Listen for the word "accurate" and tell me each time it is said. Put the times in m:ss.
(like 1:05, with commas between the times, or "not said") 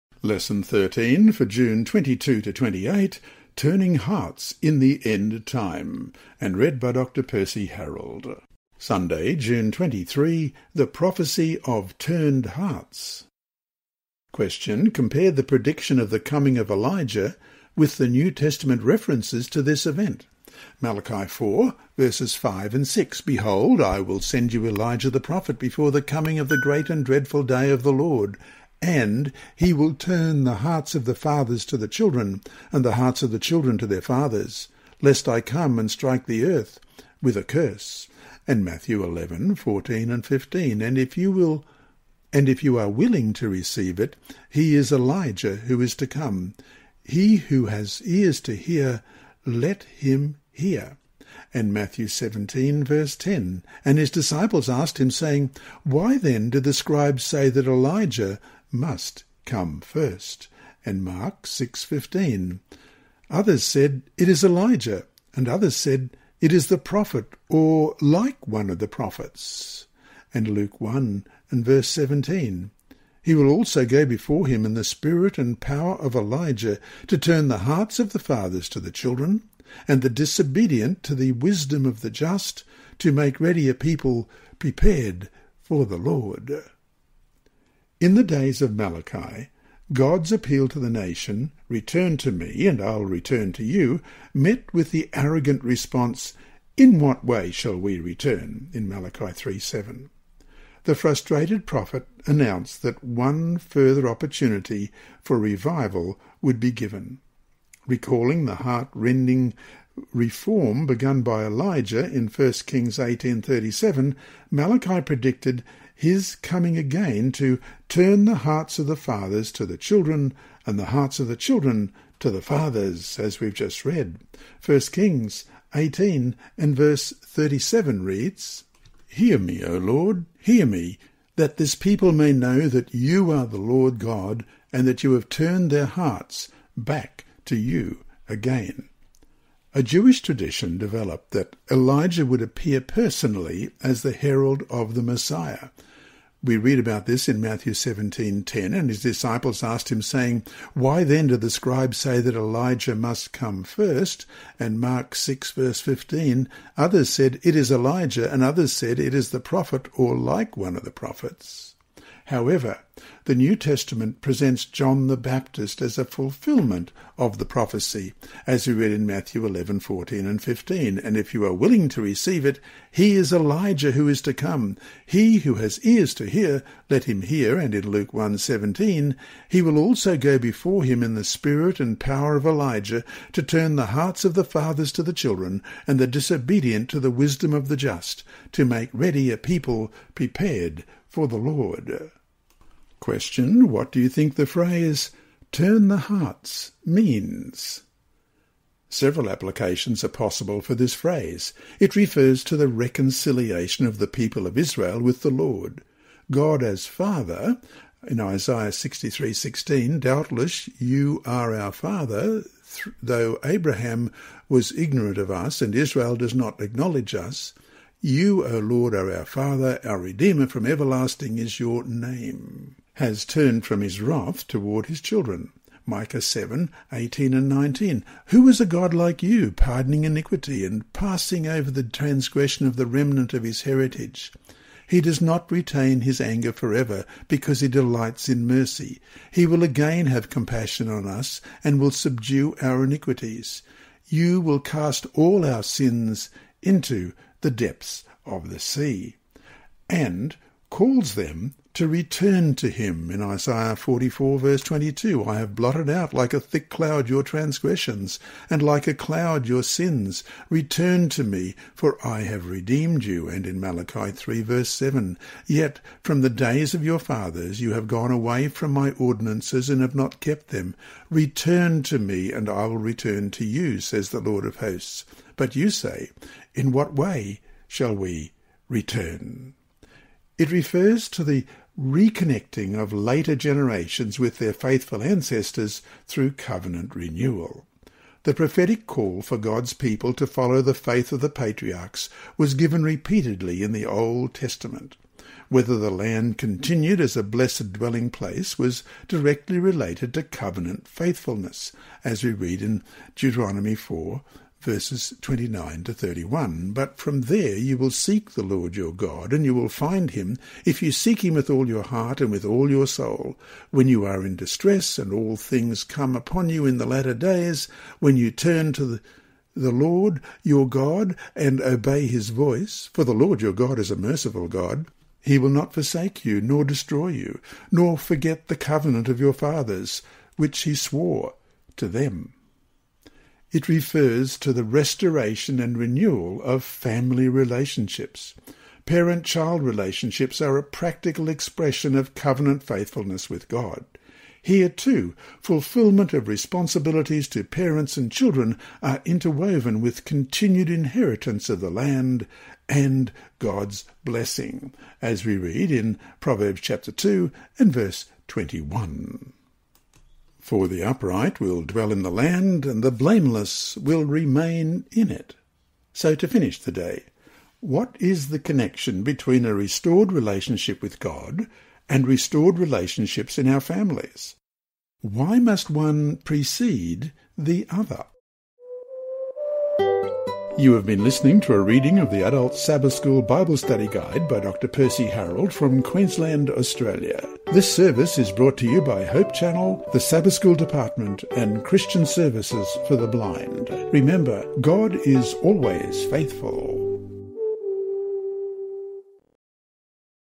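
not said.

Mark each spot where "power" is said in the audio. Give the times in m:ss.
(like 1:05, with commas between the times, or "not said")
1:15, 3:01.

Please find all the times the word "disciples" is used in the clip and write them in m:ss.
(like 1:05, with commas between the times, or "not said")
0:54, 2:29.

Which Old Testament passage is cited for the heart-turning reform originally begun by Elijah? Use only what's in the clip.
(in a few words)
1 Kings 18:37.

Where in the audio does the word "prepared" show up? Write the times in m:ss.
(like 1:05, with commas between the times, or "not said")
1:24, 3:10.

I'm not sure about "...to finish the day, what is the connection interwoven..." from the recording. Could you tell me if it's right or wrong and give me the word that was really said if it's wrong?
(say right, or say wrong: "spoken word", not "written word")
wrong: "between", not "interwoven".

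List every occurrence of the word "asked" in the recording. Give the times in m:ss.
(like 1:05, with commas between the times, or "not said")
0:54, 2:29.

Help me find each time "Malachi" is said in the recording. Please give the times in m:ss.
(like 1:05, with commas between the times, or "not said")
0:20, 1:28, 1:38, 1:54, 4:23.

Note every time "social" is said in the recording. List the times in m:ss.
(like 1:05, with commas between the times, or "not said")
not said.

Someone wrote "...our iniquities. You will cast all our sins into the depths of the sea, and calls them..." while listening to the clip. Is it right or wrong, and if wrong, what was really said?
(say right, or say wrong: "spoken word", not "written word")
right.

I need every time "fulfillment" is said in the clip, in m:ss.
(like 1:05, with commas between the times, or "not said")
2:46, 5:45.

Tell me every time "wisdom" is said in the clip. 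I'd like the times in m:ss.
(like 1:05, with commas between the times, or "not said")
1:21, 3:07.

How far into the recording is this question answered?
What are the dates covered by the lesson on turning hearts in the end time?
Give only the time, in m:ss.
0:01.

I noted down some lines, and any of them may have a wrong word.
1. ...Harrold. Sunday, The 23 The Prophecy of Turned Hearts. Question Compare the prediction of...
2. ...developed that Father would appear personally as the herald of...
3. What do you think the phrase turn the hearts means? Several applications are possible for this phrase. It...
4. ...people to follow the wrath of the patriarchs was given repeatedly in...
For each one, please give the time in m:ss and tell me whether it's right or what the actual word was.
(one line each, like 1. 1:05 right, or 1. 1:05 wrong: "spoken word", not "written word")
1. 0:07 wrong: "June", not "The"
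2. 2:20 wrong: "Elijah", not "Father"
3. 3:13 right
4. 4:49 wrong: "faith", not "wrath".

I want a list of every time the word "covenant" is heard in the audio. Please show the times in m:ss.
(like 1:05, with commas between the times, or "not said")
4:46, 5:00, 5:28, 5:42.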